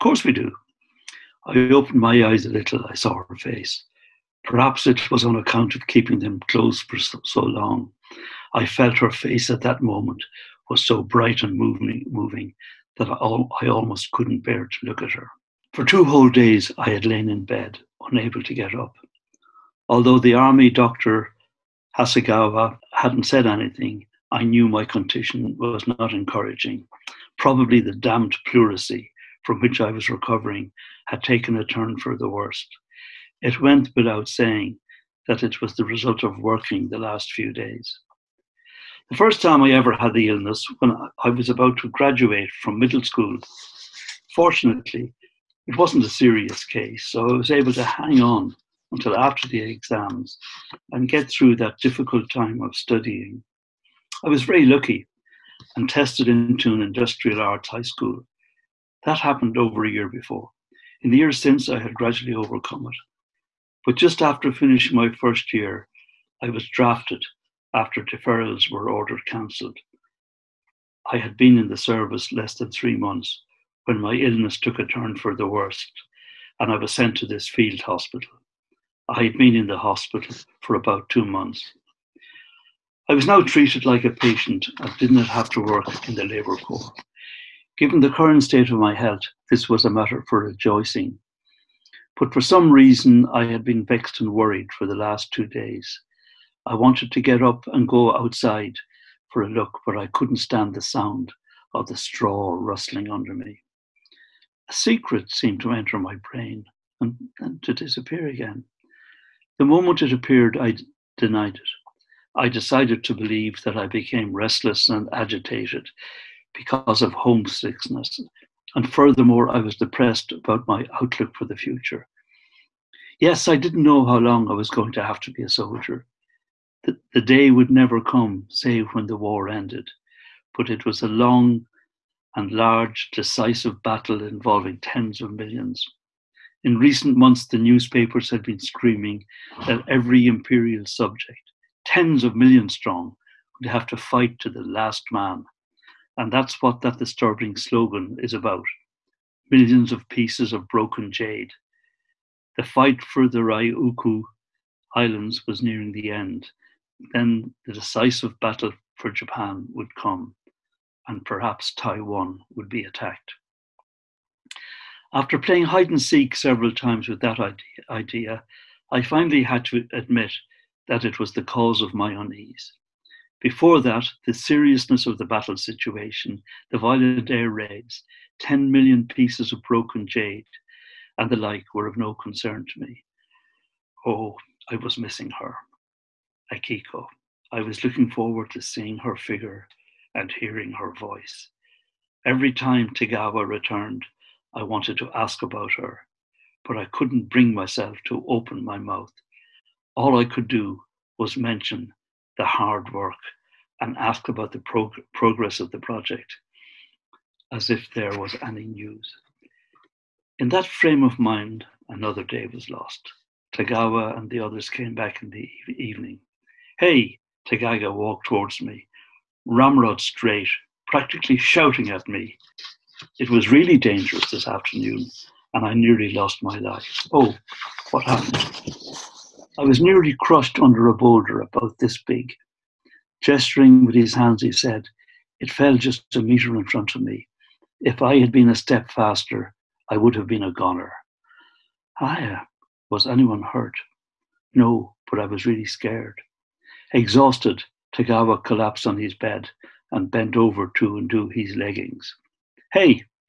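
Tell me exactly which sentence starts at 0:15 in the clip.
For two whole days, I had lain in bed, unable to get up.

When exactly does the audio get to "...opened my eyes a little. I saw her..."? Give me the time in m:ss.
0:01.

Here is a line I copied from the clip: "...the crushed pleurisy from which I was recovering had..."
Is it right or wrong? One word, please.
wrong.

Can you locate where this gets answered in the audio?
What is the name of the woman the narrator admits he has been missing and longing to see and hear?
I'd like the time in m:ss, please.
3:06.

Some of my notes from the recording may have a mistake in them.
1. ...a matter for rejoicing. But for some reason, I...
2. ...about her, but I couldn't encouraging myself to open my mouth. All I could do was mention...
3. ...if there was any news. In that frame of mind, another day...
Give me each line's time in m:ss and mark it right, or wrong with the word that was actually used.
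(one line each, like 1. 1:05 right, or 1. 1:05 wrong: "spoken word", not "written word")
1. 1:29 right
2. 3:15 wrong: "bring", not "encouraging"
3. 3:27 right.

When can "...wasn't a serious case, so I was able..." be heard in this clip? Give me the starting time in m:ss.
0:45.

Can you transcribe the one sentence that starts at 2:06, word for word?
The, the day would never come, save when the war ended.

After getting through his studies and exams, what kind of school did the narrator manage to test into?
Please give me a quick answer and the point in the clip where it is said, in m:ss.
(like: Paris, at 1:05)
industrial arts high school, at 0:56.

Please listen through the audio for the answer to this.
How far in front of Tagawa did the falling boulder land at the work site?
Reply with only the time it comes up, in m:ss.
3:56.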